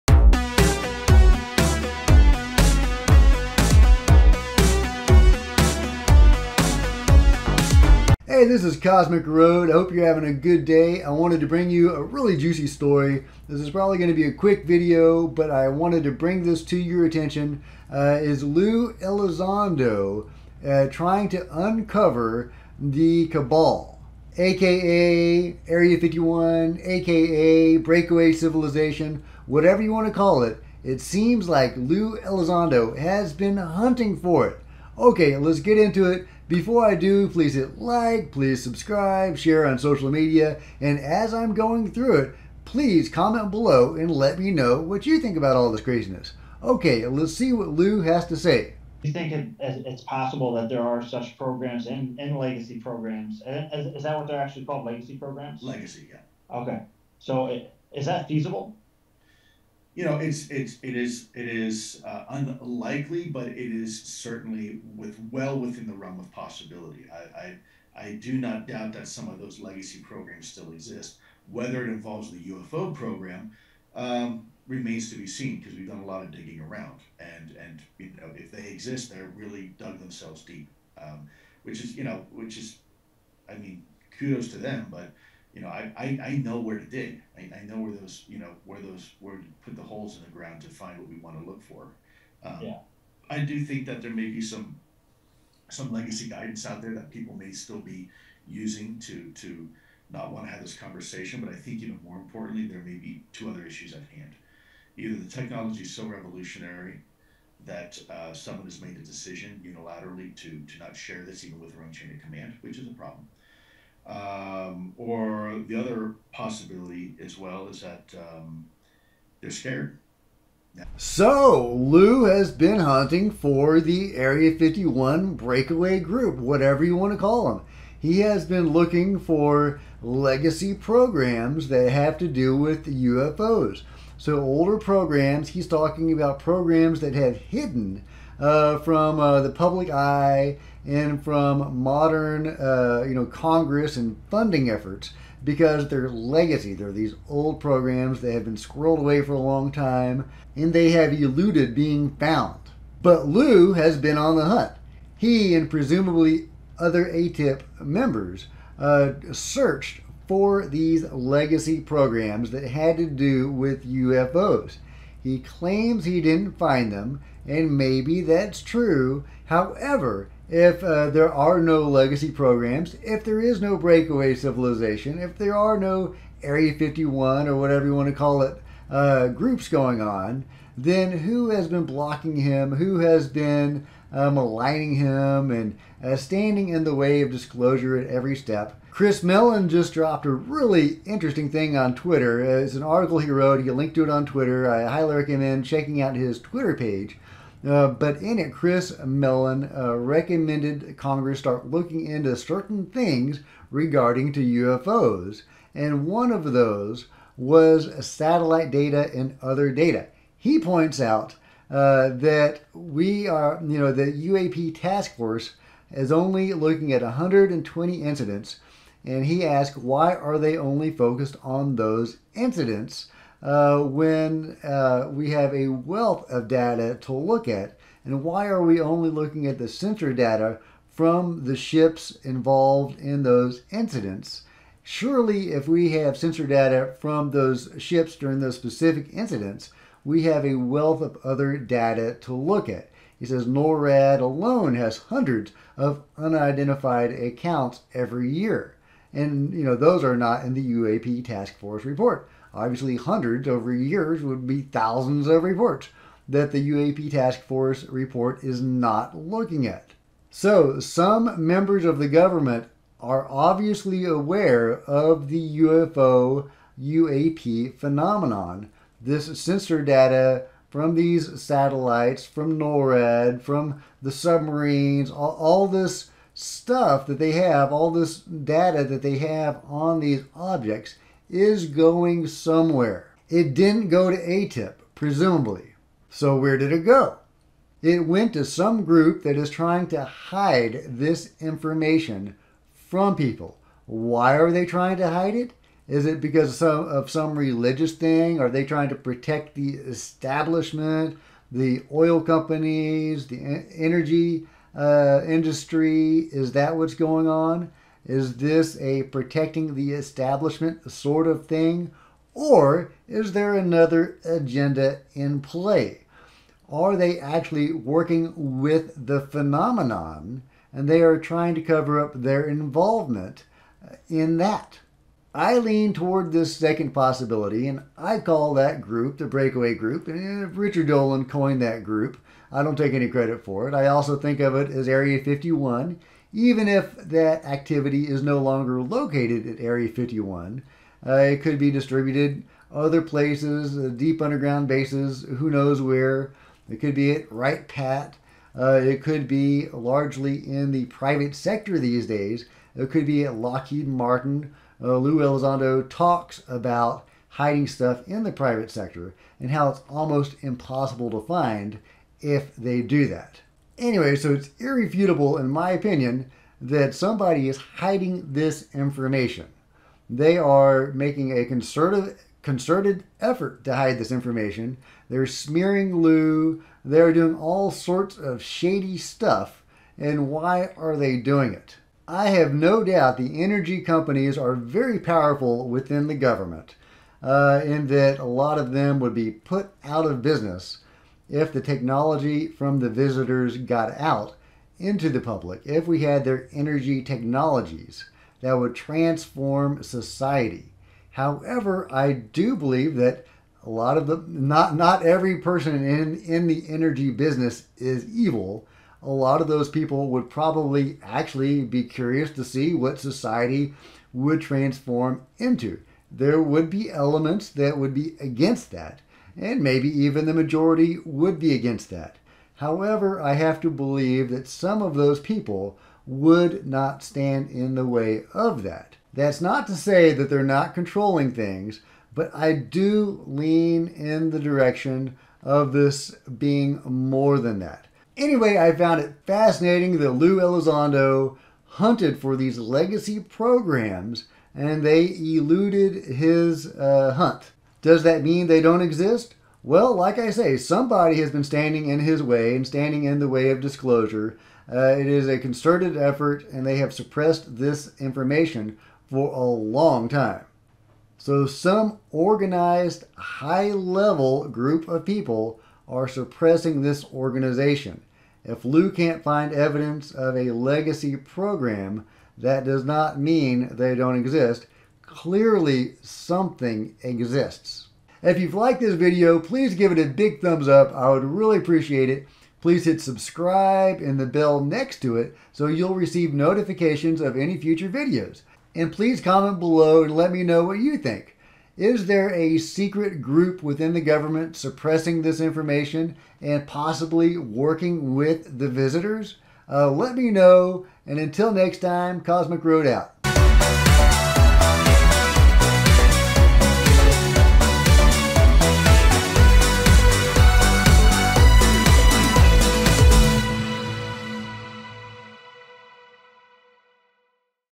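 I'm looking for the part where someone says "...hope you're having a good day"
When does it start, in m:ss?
0:09.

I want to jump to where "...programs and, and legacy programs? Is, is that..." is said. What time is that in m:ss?
0:51.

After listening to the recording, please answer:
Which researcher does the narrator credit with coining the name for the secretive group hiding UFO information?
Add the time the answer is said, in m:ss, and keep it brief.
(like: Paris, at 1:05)
Richard Dolan, at 5:30.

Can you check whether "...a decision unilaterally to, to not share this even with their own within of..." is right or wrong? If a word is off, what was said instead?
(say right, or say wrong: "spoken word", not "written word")
wrong: "chain", not "within".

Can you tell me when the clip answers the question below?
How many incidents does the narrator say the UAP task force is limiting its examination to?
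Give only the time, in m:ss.
3:37.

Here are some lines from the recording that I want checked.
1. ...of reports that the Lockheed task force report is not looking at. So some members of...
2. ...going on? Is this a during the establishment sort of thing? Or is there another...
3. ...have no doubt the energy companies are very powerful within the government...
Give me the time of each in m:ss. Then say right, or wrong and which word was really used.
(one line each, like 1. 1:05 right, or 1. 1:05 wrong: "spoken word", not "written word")
1. 4:15 wrong: "UAP", not "Lockheed"
2. 5:06 wrong: "protecting", not "during"
3. 6:22 right.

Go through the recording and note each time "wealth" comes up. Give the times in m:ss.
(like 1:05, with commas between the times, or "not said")
3:45, 4:00.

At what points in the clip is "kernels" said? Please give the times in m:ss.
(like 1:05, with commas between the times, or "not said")
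not said.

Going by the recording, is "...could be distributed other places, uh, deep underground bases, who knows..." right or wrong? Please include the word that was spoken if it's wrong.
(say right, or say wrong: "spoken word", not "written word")
right.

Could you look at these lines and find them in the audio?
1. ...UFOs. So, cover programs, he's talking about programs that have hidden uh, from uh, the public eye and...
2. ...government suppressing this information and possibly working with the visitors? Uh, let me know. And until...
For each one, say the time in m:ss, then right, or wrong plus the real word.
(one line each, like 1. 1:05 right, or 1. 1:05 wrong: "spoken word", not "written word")
1. 2:12 wrong: "older", not "cover"
2. 8:14 right.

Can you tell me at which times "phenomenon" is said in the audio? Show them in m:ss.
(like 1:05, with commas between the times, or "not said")
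4:27, 5:19.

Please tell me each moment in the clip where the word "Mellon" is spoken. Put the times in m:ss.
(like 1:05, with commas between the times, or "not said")
3:09, 3:19.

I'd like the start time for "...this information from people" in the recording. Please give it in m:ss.
4:50.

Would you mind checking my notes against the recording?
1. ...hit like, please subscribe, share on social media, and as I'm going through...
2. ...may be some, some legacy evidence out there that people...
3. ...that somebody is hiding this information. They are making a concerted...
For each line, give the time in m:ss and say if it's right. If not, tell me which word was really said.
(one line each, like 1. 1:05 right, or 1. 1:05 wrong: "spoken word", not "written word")
1. 0:37 right
2. 1:34 wrong: "guidance", not "evidence"
3. 6:06 right.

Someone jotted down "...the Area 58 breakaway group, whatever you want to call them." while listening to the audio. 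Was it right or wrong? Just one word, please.
wrong.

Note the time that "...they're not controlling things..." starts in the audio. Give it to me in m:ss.
7:10.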